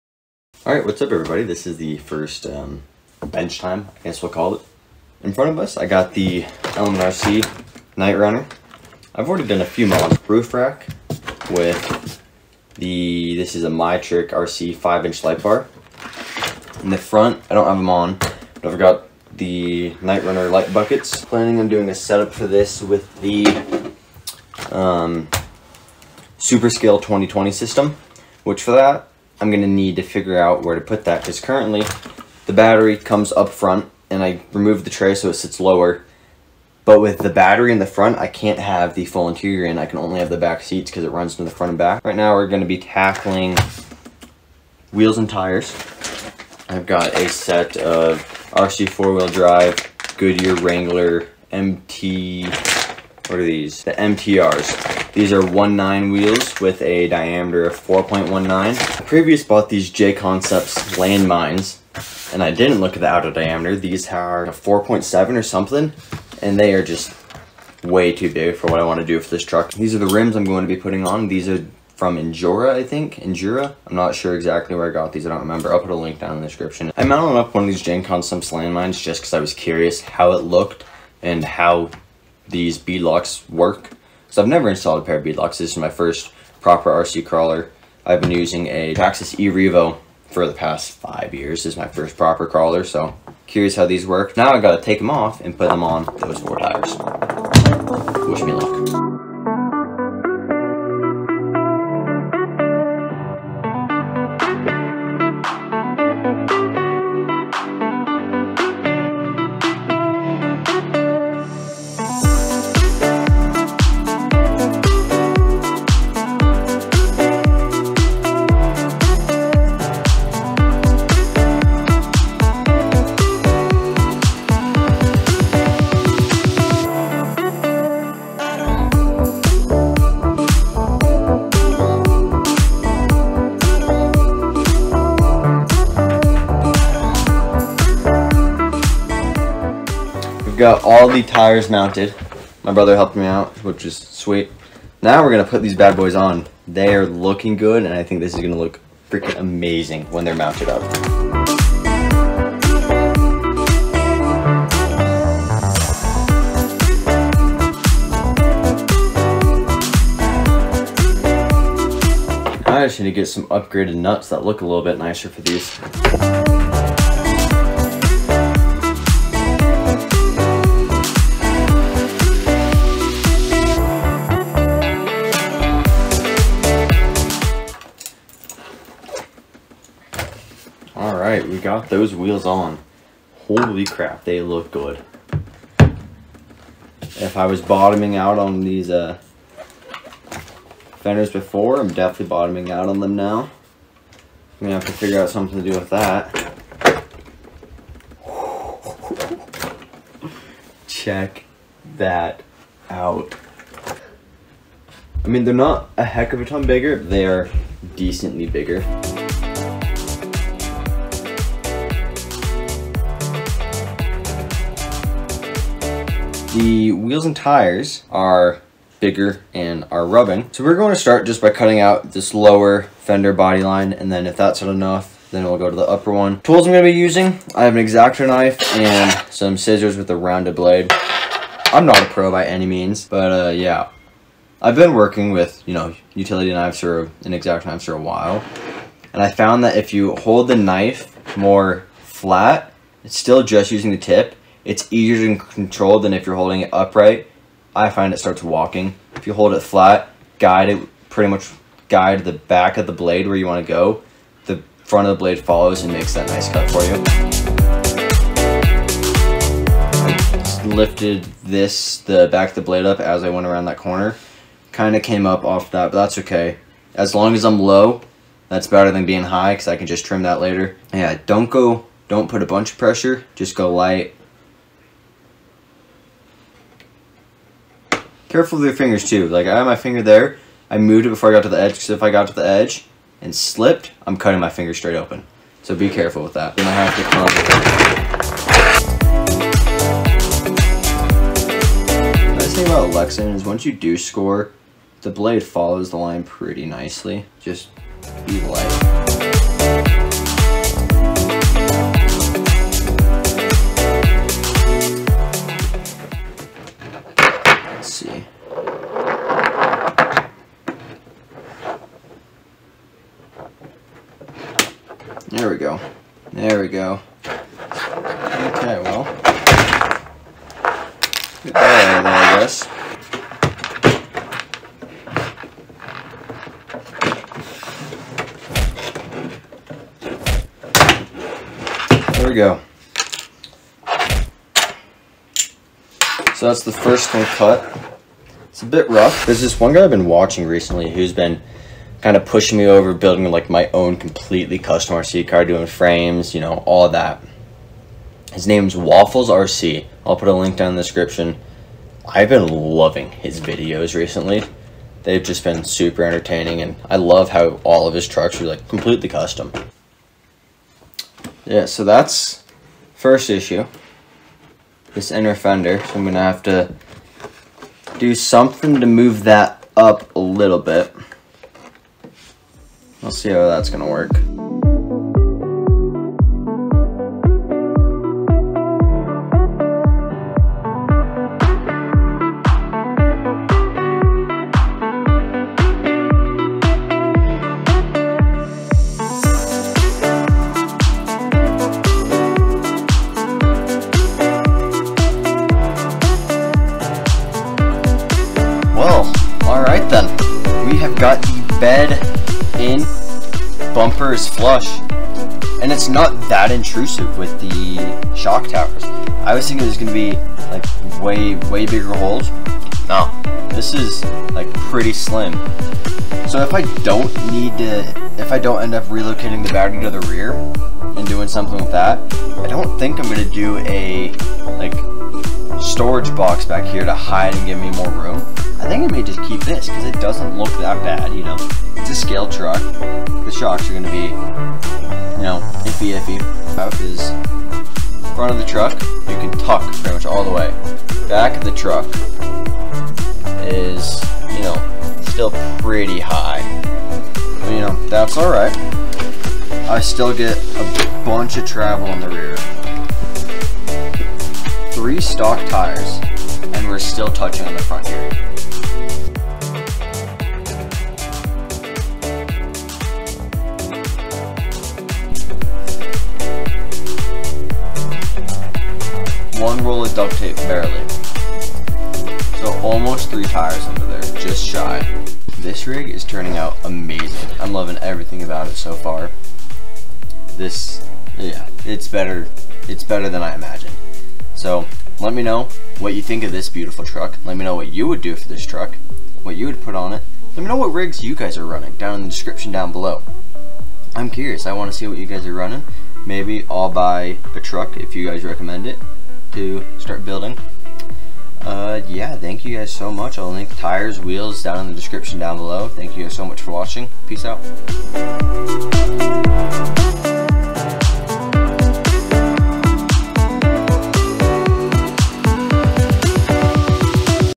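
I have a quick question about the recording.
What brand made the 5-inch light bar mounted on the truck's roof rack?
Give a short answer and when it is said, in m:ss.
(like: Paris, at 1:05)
MyTrick RC, at 0:13.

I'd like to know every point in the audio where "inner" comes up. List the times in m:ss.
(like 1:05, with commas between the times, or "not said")
6:05.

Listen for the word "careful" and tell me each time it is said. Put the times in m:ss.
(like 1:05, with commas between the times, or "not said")
4:38, 4:45.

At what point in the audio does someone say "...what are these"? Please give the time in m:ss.
0:52.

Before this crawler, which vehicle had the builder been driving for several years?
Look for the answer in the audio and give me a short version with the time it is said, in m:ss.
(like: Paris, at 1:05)
Traxxas E-Revo, at 1:28.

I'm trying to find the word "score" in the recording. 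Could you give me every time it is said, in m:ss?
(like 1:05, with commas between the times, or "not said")
4:53.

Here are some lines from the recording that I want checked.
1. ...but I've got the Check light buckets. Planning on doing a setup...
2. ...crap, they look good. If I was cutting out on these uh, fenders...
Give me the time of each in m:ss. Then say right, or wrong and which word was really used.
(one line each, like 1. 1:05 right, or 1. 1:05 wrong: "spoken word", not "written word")
1. 0:18 wrong: "Knightrunner", not "Check"
2. 3:03 wrong: "bottoming", not "cutting".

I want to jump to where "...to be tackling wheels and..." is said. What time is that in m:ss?
0:42.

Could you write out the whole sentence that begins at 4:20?
lifted this, the back of the blade up as I went around that corner.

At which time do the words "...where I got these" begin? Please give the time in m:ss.
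1:14.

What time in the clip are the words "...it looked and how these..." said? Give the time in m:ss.
1:20.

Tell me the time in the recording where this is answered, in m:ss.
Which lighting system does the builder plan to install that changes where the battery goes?
0:26.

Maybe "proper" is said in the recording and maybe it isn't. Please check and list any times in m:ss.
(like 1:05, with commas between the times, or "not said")
1:26, 1:32.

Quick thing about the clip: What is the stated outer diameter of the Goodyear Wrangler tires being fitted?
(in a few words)
4.19.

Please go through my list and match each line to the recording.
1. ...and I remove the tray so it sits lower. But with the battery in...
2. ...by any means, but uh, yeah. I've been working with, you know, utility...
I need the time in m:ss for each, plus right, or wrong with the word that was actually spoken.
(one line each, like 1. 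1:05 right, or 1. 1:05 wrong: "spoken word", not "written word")
1. 0:34 right
2. 3:52 right.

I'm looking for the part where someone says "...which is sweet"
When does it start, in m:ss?
2:23.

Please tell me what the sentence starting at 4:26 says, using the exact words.
As long as I'm low, that's better than being high because I can just trim that later.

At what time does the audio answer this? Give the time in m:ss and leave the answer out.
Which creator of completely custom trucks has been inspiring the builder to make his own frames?
5:48.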